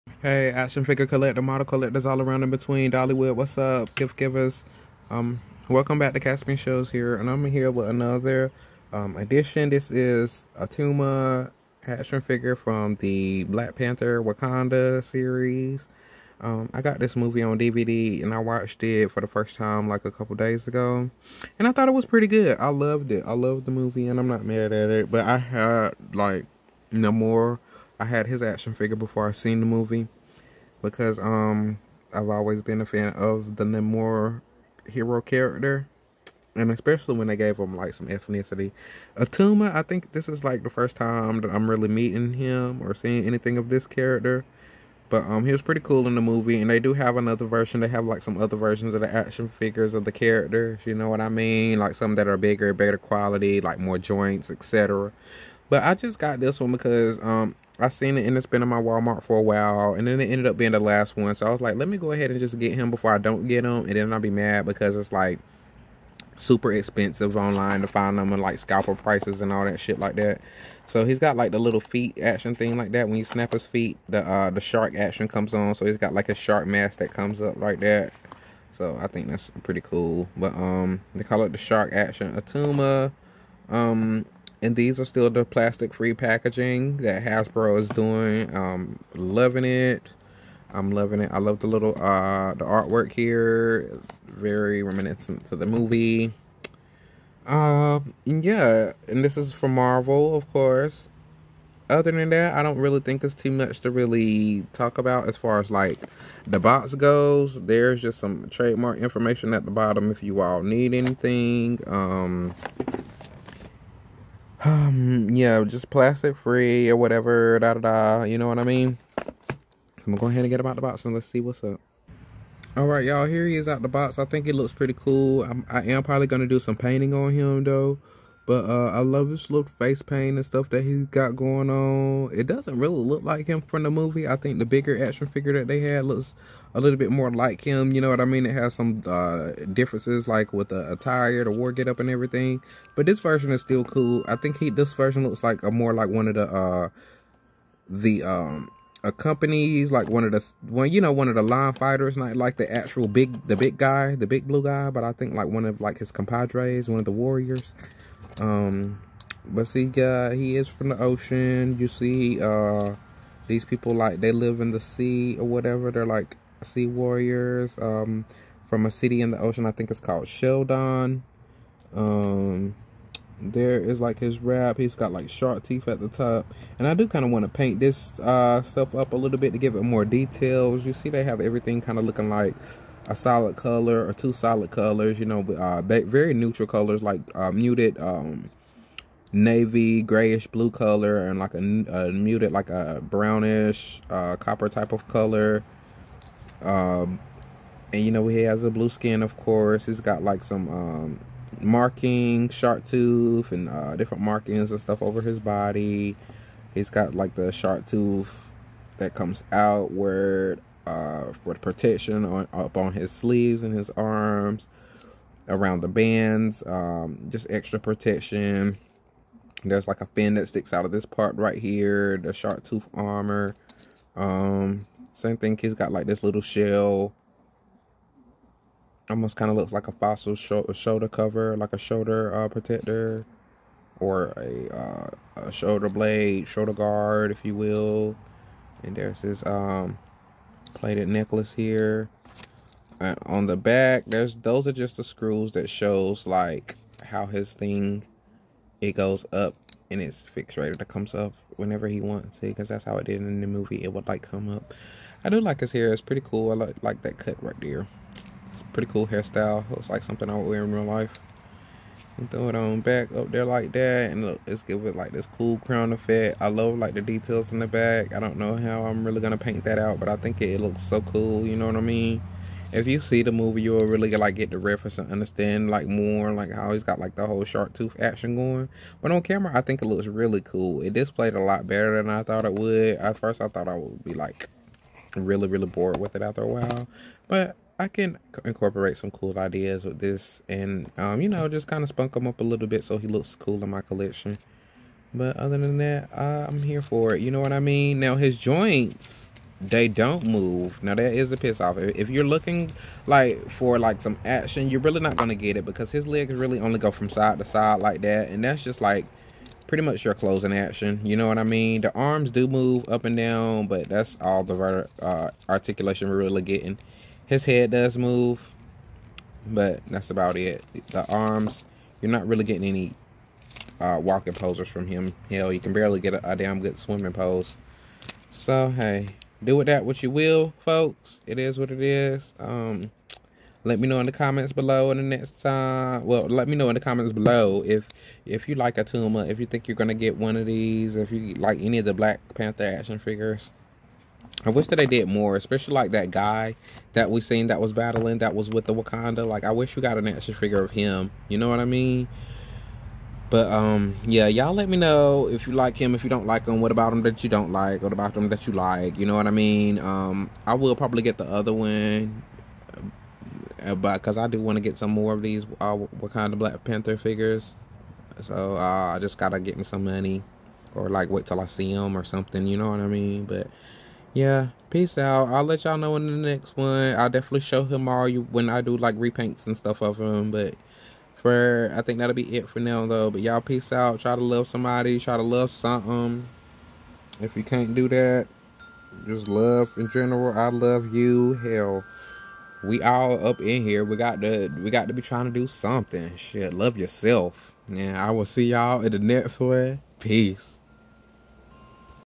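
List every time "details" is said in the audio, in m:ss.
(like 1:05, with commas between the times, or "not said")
3:00, 4:27.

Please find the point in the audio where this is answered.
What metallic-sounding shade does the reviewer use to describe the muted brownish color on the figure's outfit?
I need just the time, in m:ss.
3:14.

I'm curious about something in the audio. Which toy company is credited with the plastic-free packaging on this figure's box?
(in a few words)
Hasbro.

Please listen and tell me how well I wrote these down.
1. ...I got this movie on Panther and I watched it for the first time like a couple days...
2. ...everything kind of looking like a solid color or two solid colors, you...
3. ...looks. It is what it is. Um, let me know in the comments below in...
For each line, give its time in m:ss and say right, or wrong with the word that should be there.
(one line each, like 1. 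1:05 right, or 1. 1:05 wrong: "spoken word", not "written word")
1. 0:16 wrong: "DVD", not "Panther"
2. 3:01 right
3. 5:30 wrong: "folks", not "looks".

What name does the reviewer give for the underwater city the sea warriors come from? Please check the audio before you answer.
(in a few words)
Sheldon.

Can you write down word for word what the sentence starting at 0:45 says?
But um he was pretty cool in the movie and they do have another version.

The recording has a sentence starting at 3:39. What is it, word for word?
There's like a fin that sticks out of this part right here, the shark tooth armor.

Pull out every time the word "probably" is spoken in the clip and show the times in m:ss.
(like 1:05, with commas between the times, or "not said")
2:06, 6:00.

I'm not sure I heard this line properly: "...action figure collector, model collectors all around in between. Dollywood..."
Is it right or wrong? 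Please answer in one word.
right.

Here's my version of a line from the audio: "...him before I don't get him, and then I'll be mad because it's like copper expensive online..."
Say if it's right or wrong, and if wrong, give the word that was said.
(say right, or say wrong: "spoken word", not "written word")
wrong: "super", not "copper".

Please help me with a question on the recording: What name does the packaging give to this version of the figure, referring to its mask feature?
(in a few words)
Shark Action Attuma.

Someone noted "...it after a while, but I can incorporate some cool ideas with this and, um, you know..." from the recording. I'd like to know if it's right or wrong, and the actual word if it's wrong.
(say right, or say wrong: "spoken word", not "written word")
right.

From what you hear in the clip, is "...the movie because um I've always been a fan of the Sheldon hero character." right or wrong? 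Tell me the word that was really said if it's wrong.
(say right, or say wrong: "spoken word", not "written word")
wrong: "Namor", not "Sheldon".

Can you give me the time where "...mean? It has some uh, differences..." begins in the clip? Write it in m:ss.
2:18.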